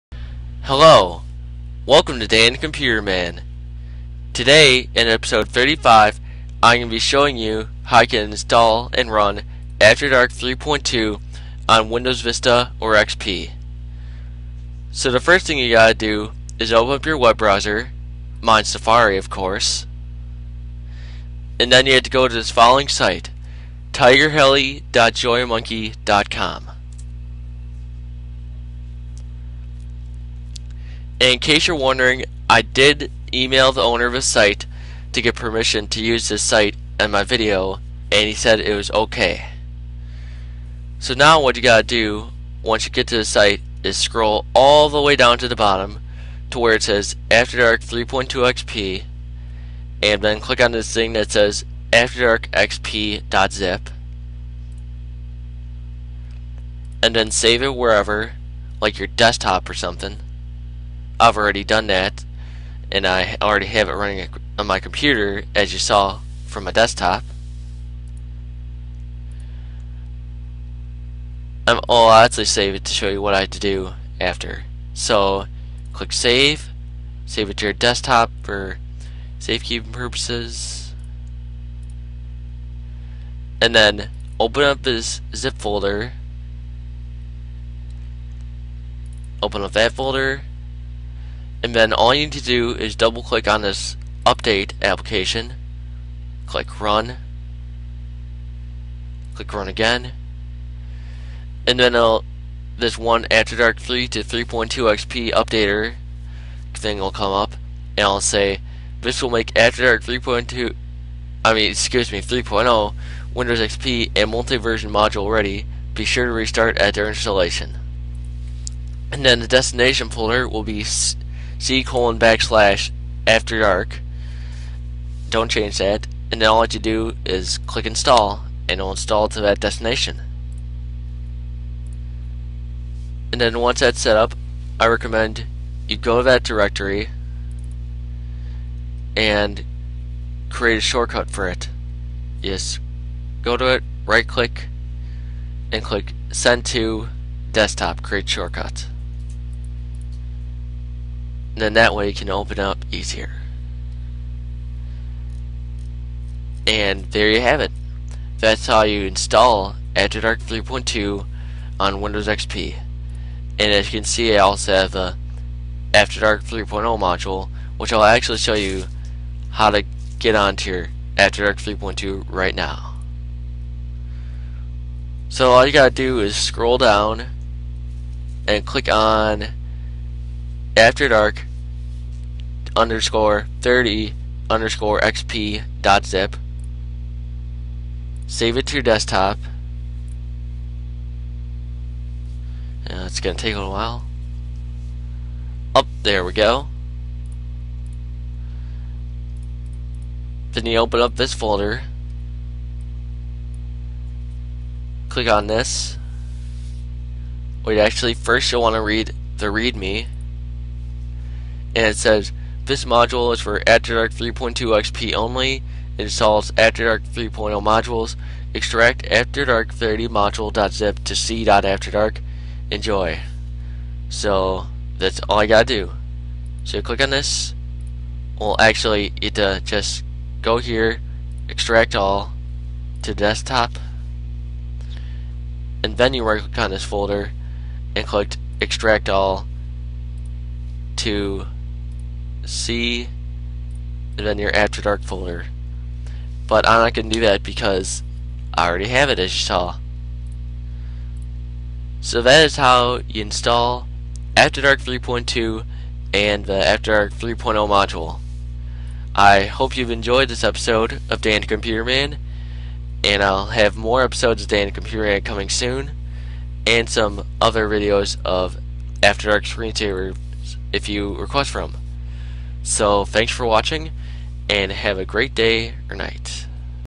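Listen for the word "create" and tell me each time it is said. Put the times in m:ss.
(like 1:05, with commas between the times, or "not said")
2:20, 2:28.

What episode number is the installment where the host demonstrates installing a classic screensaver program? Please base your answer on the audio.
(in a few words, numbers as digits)
35.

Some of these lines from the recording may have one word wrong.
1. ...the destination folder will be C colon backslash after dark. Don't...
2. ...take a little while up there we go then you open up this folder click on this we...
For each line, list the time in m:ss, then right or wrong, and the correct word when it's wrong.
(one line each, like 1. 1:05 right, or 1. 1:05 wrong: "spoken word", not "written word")
1. 1:59 right
2. 3:13 right.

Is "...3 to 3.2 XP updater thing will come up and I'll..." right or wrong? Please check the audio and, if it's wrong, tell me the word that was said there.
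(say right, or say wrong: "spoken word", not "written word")
right.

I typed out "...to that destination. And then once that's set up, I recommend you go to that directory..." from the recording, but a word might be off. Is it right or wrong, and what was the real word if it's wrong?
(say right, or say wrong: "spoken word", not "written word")
right.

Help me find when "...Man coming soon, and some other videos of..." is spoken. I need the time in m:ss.
4:25.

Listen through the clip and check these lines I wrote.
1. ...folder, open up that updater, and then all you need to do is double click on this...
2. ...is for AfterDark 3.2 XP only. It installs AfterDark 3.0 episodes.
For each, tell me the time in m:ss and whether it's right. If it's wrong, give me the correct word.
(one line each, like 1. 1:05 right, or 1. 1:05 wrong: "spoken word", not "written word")
1. 1:25 wrong: "folder", not "updater"
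2. 3:33 wrong: "modules", not "episodes".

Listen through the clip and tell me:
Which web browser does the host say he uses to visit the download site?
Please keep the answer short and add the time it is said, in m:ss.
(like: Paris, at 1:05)
Safari, at 0:18.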